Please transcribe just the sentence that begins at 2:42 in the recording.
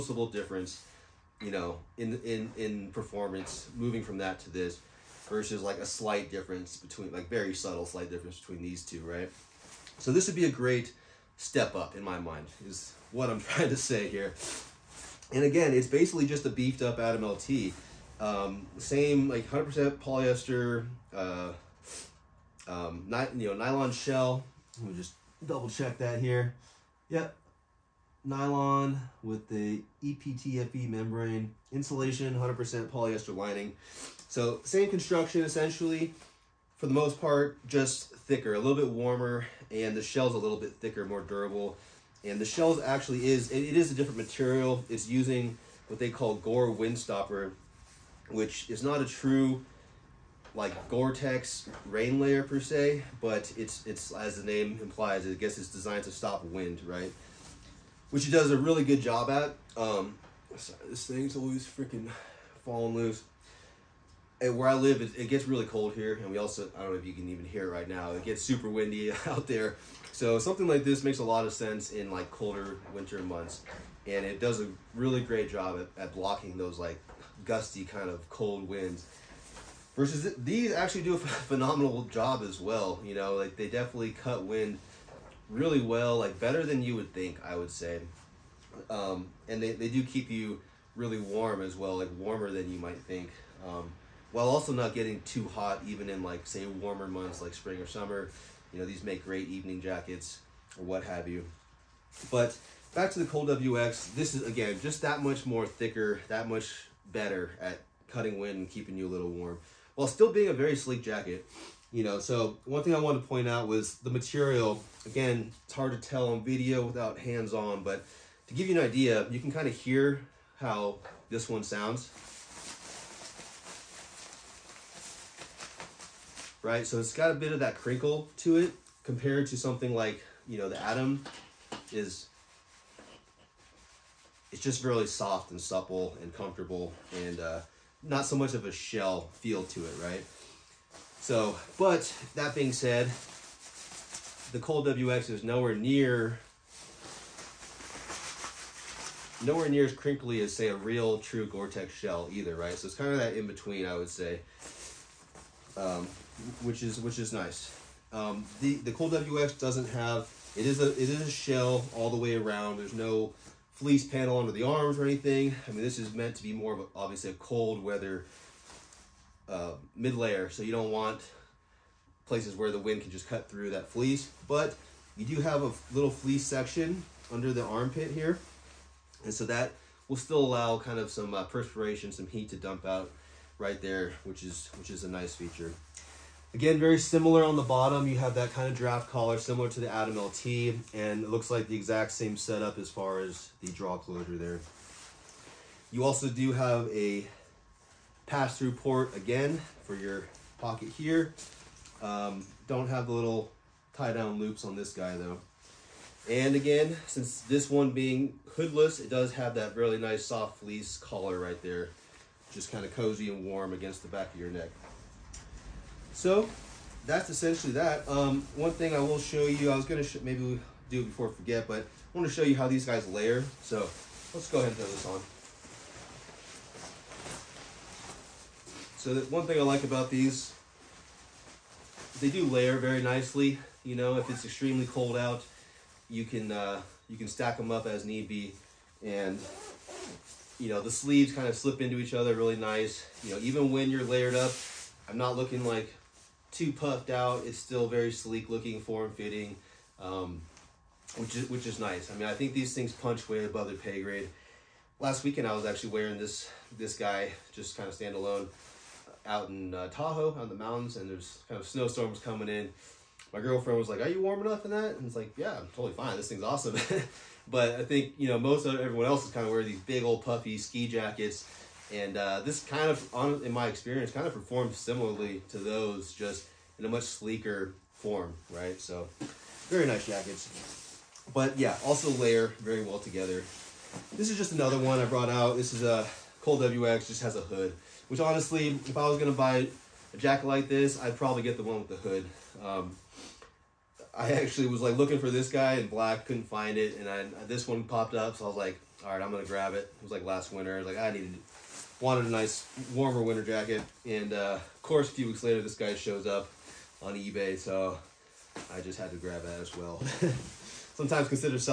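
There's no fleece panel under the arms or anything.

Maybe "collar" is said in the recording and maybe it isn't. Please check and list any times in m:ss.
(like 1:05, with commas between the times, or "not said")
3:09, 3:30.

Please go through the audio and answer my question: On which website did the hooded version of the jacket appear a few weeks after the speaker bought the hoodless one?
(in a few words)
eBay.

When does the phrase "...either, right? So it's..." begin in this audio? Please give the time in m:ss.
2:32.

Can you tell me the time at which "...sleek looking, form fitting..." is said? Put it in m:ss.
4:08.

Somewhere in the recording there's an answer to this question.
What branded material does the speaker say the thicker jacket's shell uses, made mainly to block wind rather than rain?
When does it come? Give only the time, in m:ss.
0:46.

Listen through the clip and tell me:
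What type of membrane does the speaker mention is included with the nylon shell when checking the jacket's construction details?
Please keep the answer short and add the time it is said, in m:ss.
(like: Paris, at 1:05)
EPTFE membrane, at 0:30.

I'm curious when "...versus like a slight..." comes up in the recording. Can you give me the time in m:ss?
0:05.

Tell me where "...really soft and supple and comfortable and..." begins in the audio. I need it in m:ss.
2:14.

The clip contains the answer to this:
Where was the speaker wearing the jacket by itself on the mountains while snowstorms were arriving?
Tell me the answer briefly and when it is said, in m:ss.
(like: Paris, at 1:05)
Tahoe, at 4:19.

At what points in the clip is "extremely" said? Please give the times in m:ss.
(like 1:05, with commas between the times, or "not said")
3:54.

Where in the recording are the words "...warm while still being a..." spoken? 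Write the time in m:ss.
1:49.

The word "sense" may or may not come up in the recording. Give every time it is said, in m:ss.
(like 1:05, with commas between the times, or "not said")
1:11.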